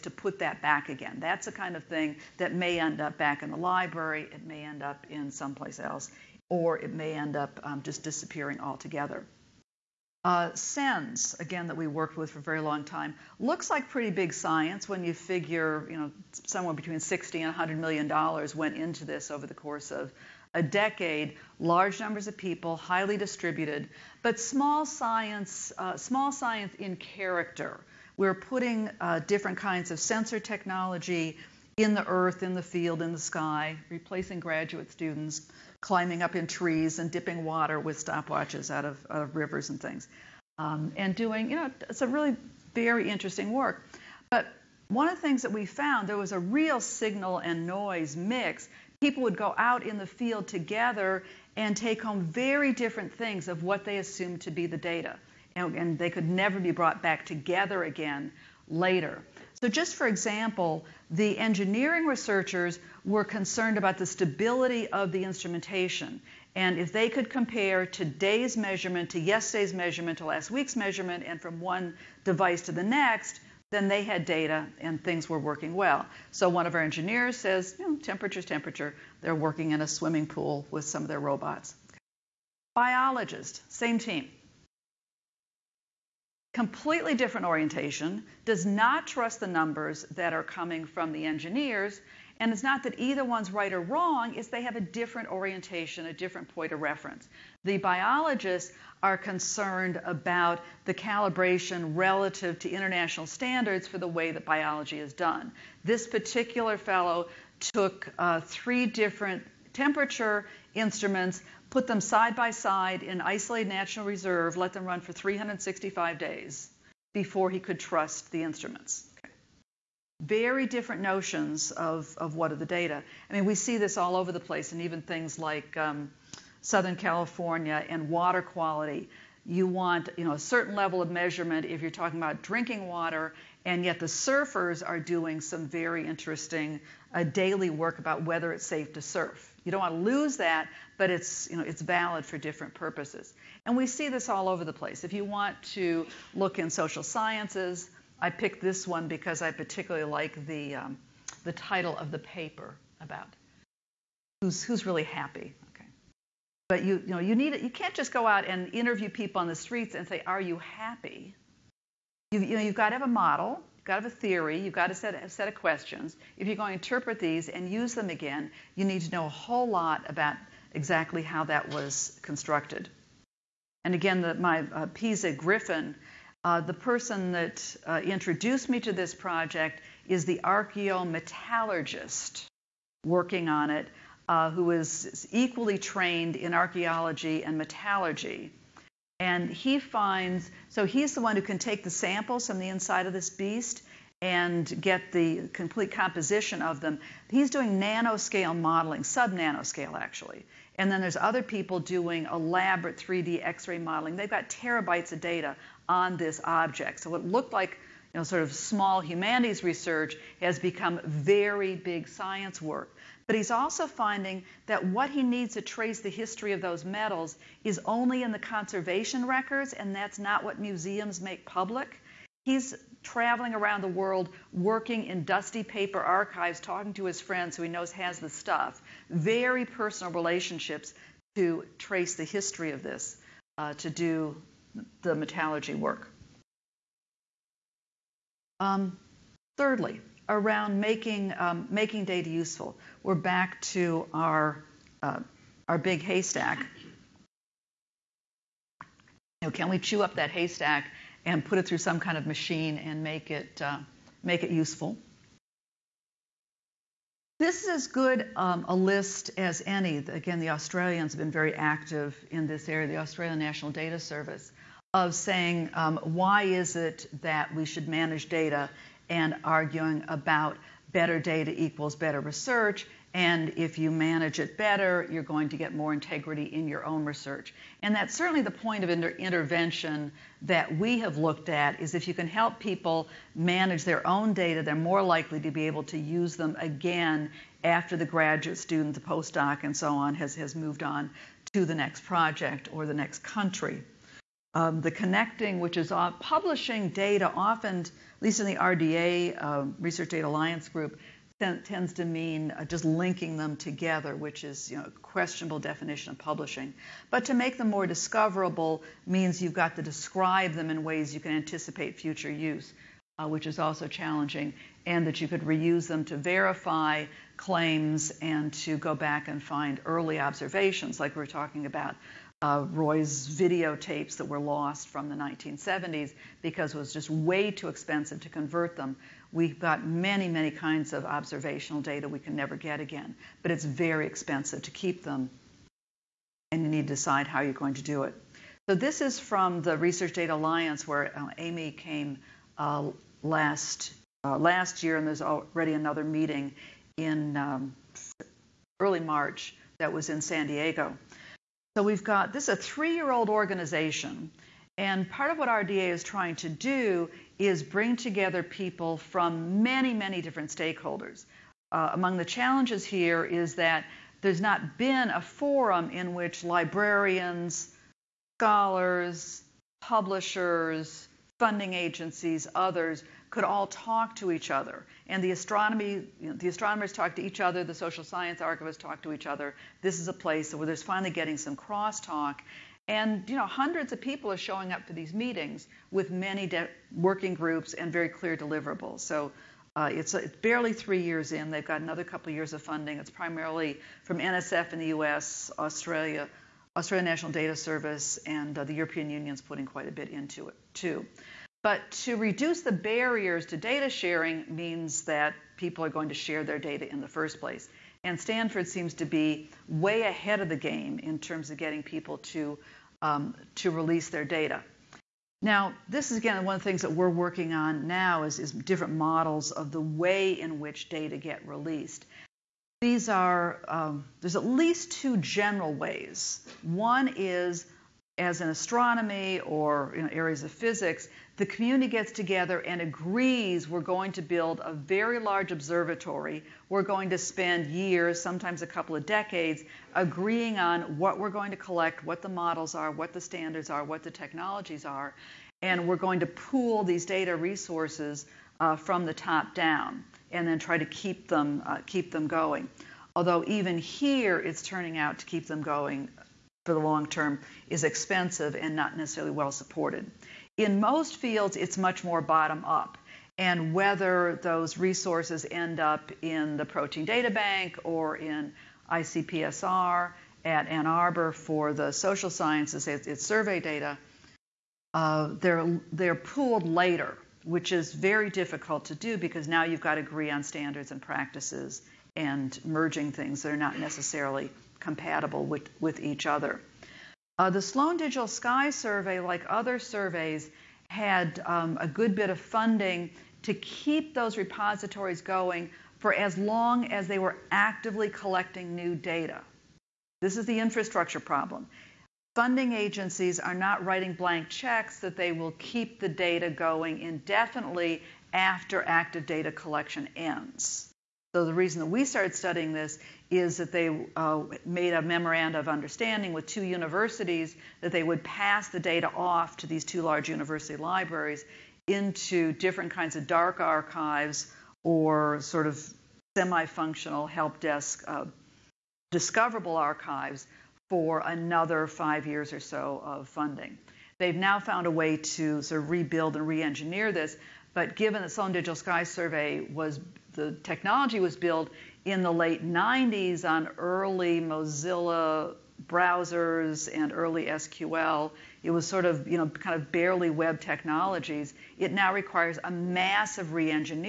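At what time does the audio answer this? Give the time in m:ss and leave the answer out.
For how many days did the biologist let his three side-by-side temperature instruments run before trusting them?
1:55.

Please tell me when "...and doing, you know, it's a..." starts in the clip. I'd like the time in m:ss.
0:40.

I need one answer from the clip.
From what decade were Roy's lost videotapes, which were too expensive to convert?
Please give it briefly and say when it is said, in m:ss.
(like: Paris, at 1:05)
1970s, at 5:25.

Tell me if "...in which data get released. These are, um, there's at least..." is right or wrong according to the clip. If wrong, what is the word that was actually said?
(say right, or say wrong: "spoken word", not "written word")
right.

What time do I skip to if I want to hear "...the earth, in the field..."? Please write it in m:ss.
0:31.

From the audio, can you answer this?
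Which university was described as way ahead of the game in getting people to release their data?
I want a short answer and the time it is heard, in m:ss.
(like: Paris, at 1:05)
Stanford, at 6:48.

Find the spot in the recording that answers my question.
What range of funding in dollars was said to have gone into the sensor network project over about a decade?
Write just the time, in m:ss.
0:16.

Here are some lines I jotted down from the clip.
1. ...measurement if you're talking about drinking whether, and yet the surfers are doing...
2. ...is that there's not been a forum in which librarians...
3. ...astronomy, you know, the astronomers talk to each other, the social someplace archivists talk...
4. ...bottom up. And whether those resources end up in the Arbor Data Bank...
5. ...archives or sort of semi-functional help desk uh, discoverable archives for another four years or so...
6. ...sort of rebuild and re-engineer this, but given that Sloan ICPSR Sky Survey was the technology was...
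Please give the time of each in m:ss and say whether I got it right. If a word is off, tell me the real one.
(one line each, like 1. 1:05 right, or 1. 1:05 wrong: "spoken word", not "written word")
1. 2:11 wrong: "water", not "whether"
2. 6:03 right
3. 6:15 wrong: "science", not "someplace"
4. 7:42 wrong: "Protein", not "Arbor"
5. 8:43 wrong: "five", not "four"
6. 8:55 wrong: "Digital", not "ICPSR".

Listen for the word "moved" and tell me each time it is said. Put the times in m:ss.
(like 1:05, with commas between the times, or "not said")
4:50.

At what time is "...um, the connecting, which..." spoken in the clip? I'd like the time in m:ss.
4:54.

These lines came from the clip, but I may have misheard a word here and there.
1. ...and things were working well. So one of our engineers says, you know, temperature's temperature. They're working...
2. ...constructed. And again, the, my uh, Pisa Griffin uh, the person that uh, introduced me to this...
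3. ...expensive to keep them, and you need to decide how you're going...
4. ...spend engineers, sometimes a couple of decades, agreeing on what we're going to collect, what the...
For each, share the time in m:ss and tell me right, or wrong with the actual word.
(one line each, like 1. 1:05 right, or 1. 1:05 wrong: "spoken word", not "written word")
1. 1:14 right
2. 2:52 right
3. 5:34 right
4. 7:17 wrong: "years", not "engineers".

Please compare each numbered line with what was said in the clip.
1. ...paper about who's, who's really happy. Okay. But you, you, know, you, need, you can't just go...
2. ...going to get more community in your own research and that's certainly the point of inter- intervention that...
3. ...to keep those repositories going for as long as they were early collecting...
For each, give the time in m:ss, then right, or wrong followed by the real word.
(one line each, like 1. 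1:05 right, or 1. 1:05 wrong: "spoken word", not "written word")
1. 2:32 right
2. 4:35 wrong: "integrity", not "community"
3. 8:13 wrong: "actively", not "early".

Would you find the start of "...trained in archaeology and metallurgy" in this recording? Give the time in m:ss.
3:05.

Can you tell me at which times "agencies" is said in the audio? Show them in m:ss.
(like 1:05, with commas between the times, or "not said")
6:11, 8:22.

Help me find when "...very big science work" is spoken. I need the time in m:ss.
3:31.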